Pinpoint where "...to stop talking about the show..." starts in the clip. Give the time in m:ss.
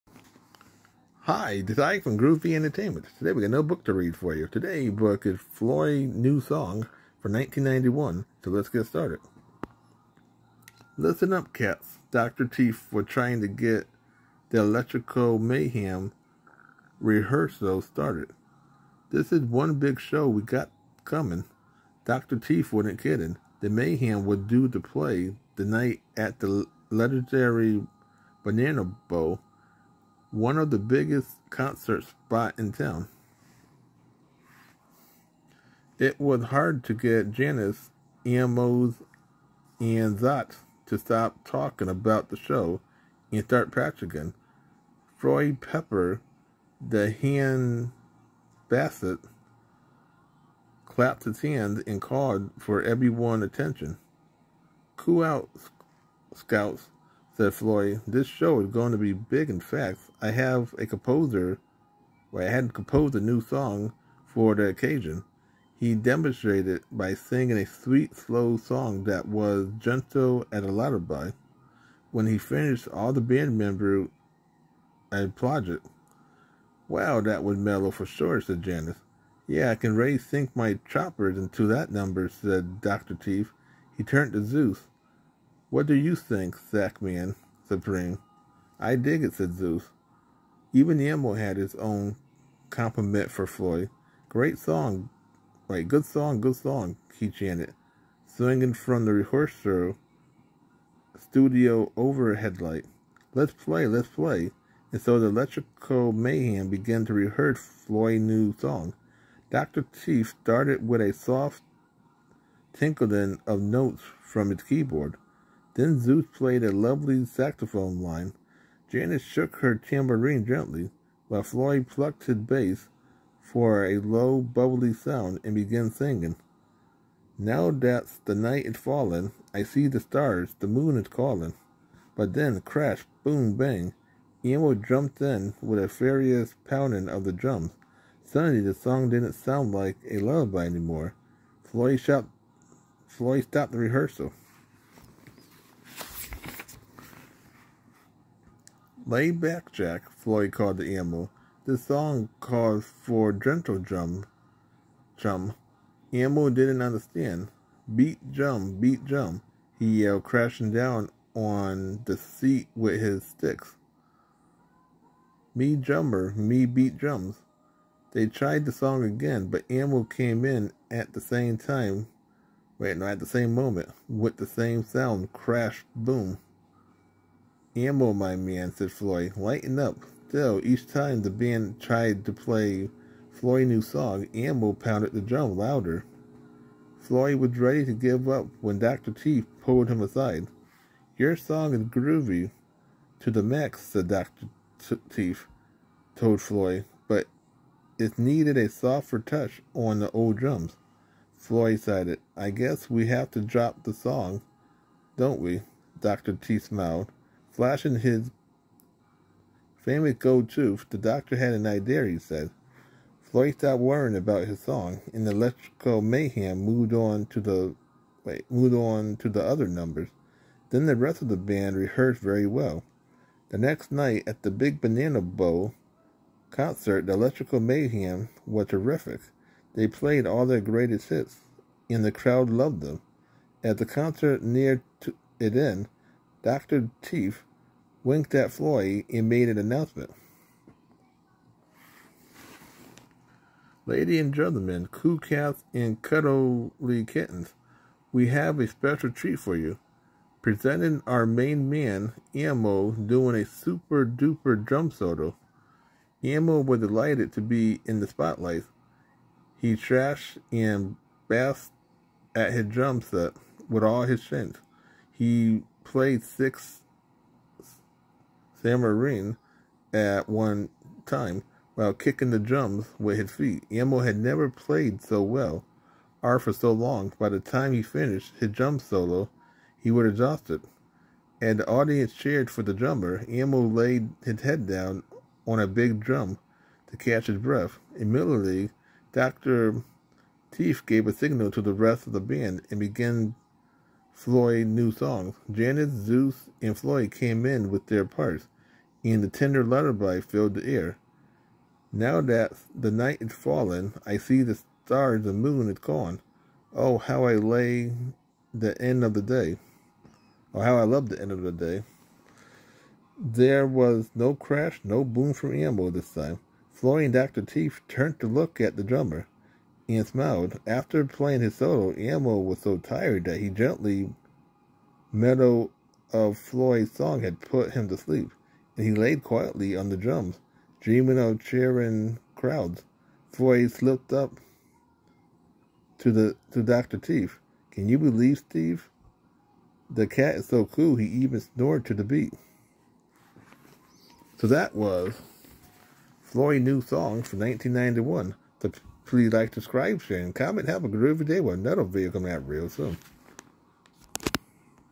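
0:40.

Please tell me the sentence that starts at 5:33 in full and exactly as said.
Floyd slipped up to the to Dr.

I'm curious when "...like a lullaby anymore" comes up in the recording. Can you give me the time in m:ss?
2:19.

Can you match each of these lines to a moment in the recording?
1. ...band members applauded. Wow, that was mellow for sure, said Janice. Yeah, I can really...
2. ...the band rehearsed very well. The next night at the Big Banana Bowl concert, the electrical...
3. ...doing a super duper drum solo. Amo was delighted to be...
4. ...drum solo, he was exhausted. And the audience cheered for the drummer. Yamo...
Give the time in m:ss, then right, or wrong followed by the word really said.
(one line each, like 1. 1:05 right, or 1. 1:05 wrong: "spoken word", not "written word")
1. 1:13 right
2. 3:41 right
3. 4:12 right
4. 4:38 right.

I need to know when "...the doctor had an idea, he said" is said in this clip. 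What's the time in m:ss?
3:30.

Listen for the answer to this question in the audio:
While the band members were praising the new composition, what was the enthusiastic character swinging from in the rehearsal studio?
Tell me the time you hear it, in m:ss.
1:41.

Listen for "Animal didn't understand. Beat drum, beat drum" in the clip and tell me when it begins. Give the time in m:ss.
2:36.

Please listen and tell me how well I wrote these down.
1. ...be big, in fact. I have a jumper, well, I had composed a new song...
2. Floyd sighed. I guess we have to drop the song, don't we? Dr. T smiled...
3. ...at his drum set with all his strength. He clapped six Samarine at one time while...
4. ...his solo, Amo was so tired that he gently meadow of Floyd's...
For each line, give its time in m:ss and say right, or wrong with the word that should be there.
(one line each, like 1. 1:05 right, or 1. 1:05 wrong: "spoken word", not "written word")
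1. 0:58 wrong: "composer", not "jumper"
2. 3:21 right
3. 4:22 wrong: "played", not "clapped"
4. 5:21 right.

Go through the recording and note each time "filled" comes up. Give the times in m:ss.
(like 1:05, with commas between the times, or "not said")
5:00.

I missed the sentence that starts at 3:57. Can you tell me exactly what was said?
Teeth winked at Floyd and made an announcement.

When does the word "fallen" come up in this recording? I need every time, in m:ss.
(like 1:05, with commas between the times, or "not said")
2:08, 5:03.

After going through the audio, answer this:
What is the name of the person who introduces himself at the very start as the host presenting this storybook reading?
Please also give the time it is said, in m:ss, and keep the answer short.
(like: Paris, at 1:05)
Ike, at 0:01.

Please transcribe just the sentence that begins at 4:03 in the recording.
Lady and gentlemen, coo cats and cuddly kittens, we have a special treat for you.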